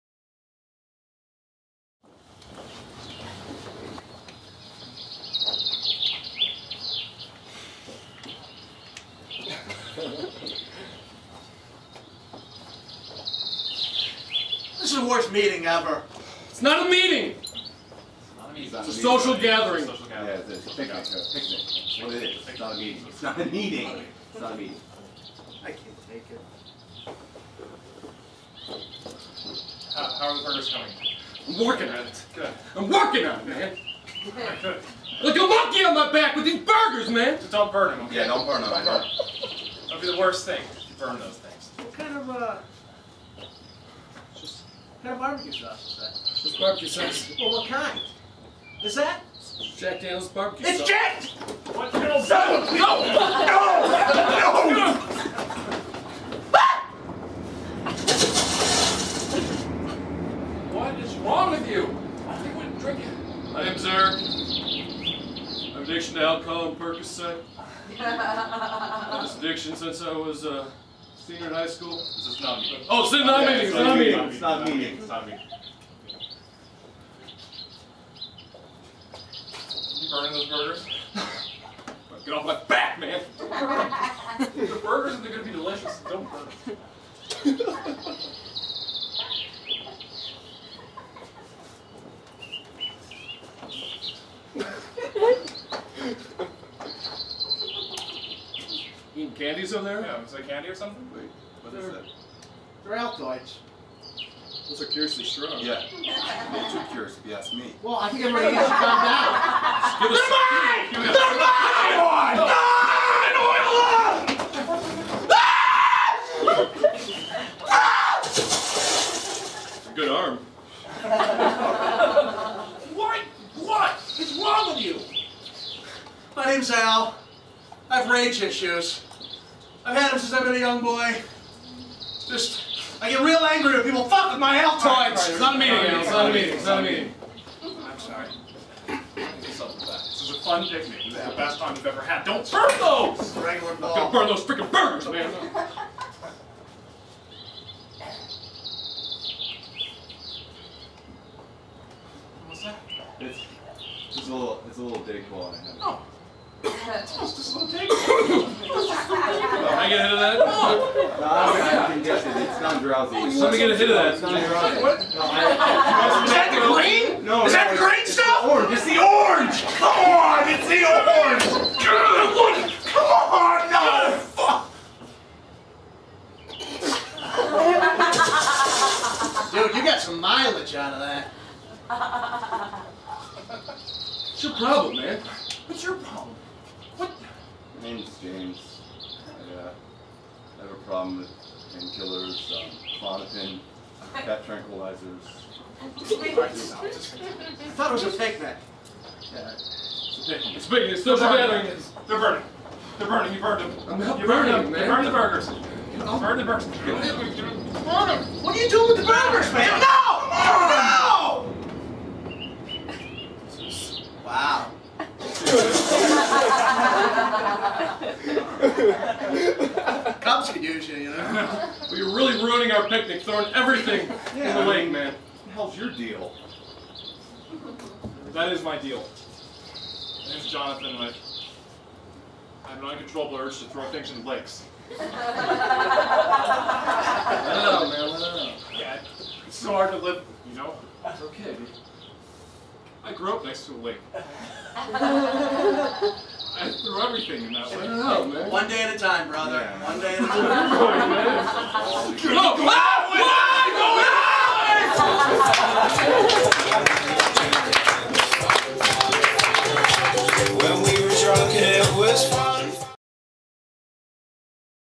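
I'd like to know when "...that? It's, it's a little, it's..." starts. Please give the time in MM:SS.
02:32.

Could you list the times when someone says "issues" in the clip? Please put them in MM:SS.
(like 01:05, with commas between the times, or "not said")
02:08.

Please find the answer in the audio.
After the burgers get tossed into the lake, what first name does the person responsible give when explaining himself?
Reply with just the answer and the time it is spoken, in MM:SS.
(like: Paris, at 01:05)
Jonathan, at 03:50.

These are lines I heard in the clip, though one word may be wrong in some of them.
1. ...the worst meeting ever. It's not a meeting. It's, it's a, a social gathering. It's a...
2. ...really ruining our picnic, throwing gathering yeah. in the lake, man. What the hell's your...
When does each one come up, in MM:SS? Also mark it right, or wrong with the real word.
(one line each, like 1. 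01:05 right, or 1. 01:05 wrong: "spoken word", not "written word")
1. 00:14 right
2. 03:42 wrong: "everything", not "gathering".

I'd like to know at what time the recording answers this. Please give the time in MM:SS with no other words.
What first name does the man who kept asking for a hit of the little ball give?
03:08.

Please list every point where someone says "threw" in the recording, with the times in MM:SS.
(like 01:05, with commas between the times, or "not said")
04:06.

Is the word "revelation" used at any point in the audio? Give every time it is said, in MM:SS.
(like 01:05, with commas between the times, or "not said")
not said.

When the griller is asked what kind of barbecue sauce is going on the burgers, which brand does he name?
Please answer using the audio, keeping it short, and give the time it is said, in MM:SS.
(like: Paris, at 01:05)
Jack Daniels, at 00:49.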